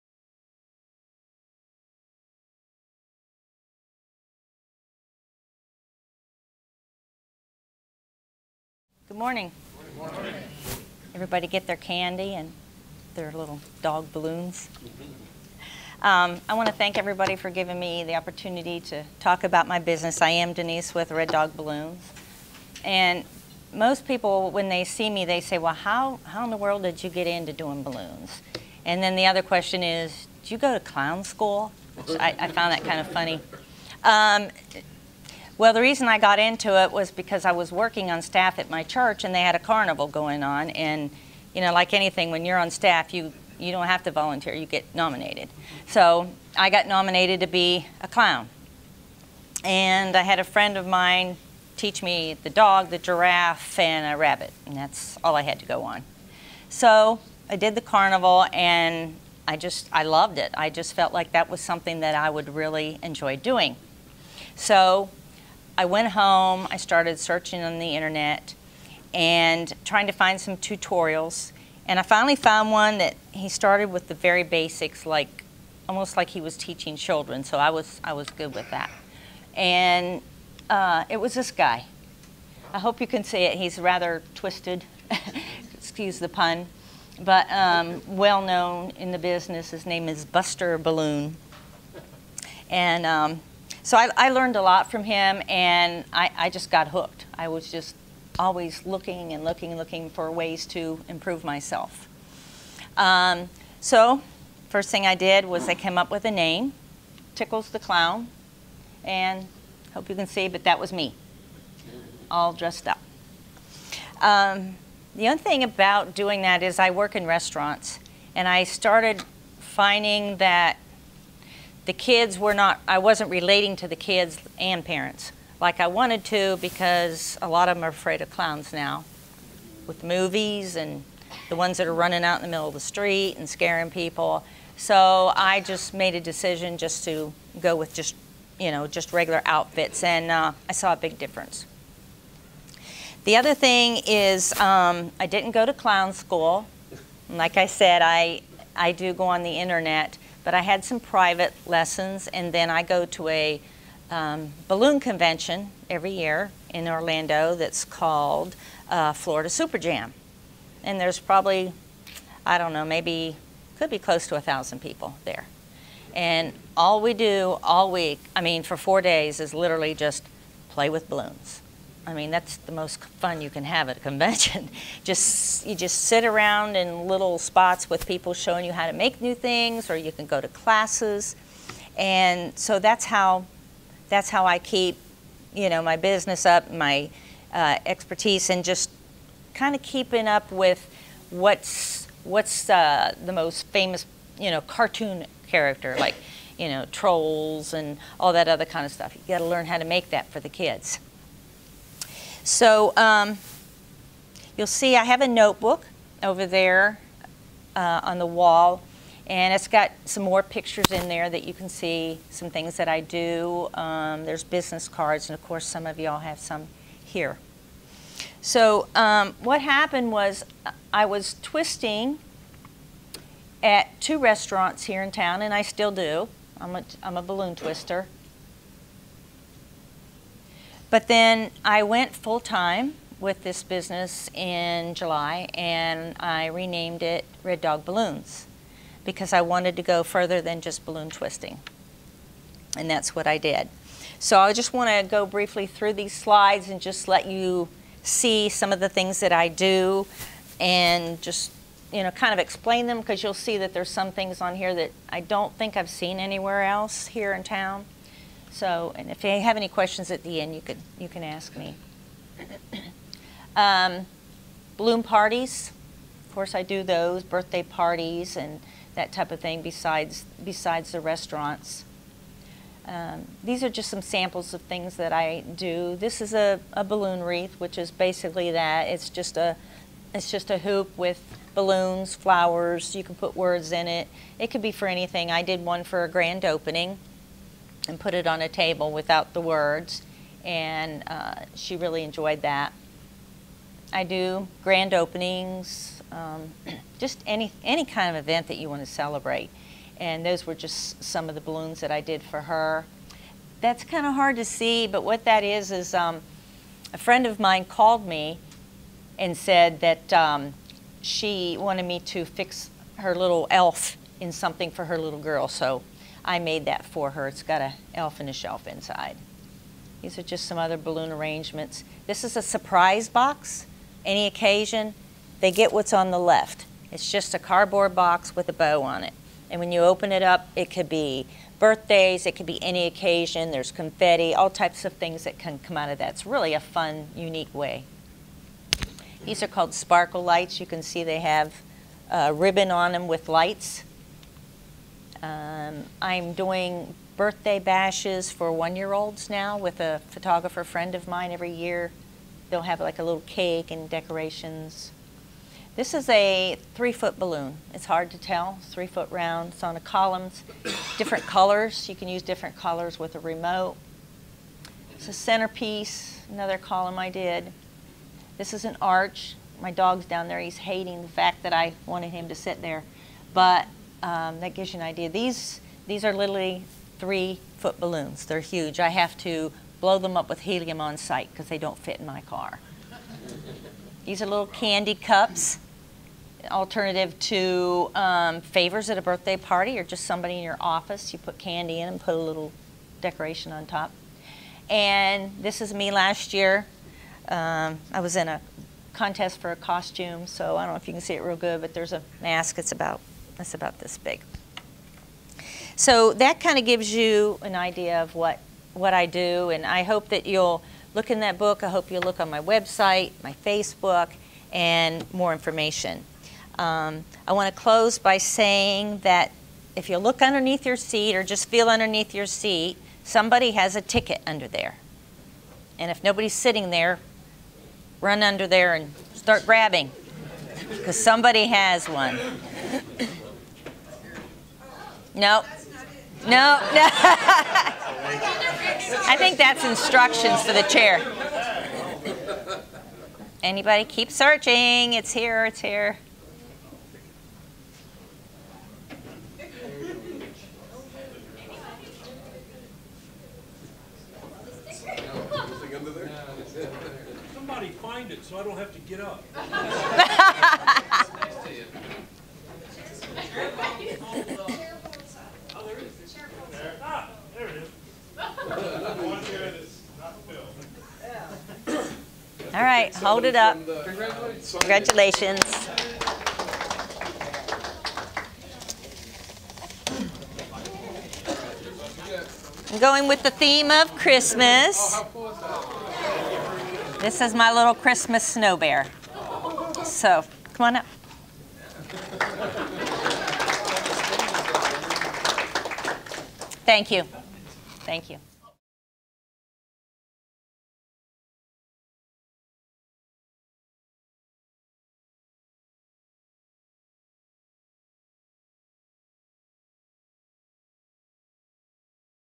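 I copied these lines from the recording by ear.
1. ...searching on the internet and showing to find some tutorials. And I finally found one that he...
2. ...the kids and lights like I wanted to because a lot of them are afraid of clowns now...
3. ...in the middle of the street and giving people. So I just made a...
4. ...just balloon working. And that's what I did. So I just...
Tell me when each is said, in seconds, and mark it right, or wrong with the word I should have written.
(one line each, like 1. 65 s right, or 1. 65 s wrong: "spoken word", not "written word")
1. 67 s wrong: "trying", not "showing"
2. 123 s wrong: "parents", not "lights"
3. 132 s wrong: "scaring", not "giving"
4. 240 s wrong: "twisting", not "working".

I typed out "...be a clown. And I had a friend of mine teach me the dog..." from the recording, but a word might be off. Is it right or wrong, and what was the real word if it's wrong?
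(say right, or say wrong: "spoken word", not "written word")
right.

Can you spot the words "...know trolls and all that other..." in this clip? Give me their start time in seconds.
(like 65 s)
196 s.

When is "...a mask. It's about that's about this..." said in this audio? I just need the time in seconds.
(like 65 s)
401 s.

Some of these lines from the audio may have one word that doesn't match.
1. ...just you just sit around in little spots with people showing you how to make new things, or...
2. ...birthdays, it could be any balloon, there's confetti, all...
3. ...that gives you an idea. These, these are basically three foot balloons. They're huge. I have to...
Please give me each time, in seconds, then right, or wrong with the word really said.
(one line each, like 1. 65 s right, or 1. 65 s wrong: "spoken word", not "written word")
1. 175 s right
2. 331 s wrong: "occasion", not "balloon"
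3. 374 s wrong: "literally", not "basically".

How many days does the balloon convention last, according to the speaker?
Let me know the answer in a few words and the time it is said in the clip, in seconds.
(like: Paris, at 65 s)
4, at 168 s.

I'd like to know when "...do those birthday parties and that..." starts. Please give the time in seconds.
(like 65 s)
266 s.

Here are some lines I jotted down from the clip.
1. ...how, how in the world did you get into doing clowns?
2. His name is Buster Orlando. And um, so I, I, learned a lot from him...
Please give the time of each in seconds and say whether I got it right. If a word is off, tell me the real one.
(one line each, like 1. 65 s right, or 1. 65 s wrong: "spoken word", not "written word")
1. 25 s wrong: "balloons", not "clowns"
2. 89 s wrong: "Balloon", not "Orlando".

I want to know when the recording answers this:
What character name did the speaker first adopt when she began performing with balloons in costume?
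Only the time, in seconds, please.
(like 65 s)
107 s.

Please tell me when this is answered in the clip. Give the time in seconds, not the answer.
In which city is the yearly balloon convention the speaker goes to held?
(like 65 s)
156 s.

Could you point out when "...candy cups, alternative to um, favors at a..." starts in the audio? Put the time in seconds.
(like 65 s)
384 s.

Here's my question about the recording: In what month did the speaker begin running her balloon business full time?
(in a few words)
July.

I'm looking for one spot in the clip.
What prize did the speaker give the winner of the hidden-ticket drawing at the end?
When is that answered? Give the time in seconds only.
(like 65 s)
487 s.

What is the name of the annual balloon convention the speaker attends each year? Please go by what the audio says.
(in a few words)
Florida Super Jam.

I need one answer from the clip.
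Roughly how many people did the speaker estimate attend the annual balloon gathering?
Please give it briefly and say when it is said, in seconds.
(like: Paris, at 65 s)
1000, at 164 s.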